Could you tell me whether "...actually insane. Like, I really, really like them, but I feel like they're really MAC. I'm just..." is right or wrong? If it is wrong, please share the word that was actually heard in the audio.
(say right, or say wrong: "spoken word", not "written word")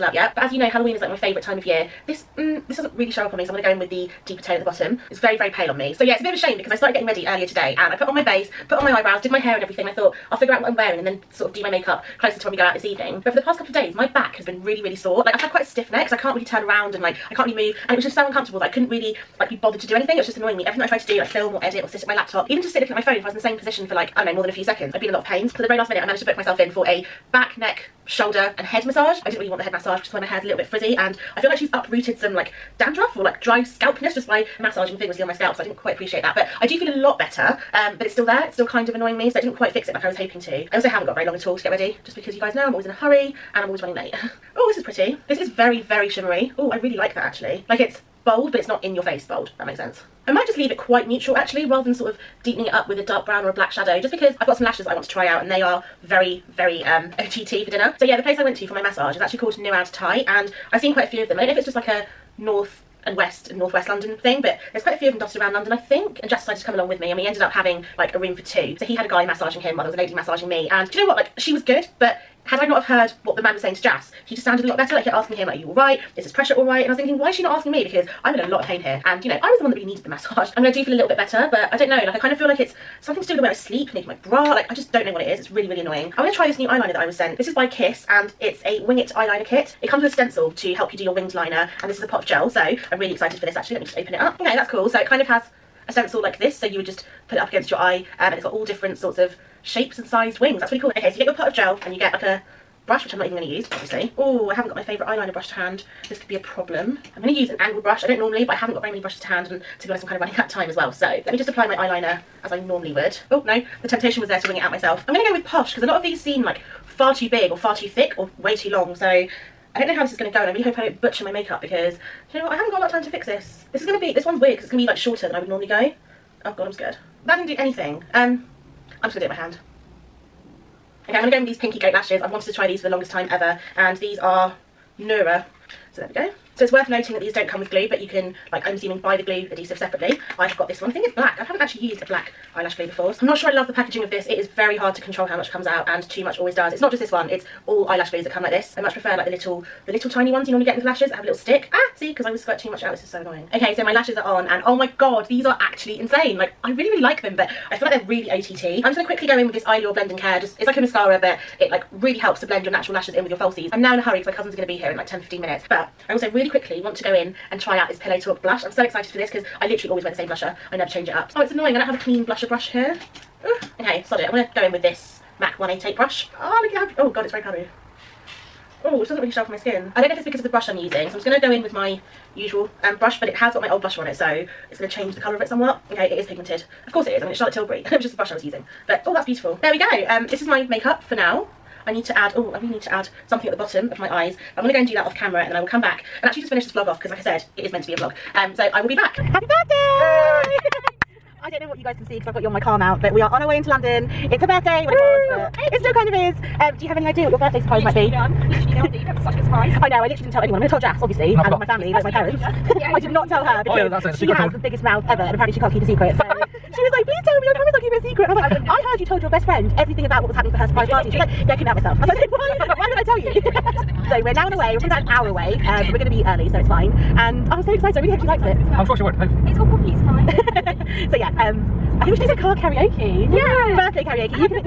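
wrong: "OTT", not "MAC".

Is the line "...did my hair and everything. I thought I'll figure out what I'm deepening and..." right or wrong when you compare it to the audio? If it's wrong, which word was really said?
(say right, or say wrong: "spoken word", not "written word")
wrong: "wearing", not "deepening".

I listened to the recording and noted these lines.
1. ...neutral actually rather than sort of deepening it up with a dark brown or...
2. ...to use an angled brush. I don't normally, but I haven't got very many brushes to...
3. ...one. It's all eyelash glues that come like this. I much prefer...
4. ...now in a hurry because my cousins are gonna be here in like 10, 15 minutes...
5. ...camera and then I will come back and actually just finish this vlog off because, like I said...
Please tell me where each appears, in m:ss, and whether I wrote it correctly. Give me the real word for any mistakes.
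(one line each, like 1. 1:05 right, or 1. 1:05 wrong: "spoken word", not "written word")
1. 0:51 right
2. 1:47 right
3. 2:27 right
4. 2:43 right
5. 3:15 right.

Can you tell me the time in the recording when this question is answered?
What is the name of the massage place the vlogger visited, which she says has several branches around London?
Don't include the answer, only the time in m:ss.
0:59.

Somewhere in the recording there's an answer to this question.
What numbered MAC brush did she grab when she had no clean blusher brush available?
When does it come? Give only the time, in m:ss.
2:55.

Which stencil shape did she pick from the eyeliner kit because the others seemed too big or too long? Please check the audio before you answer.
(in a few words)
Posh.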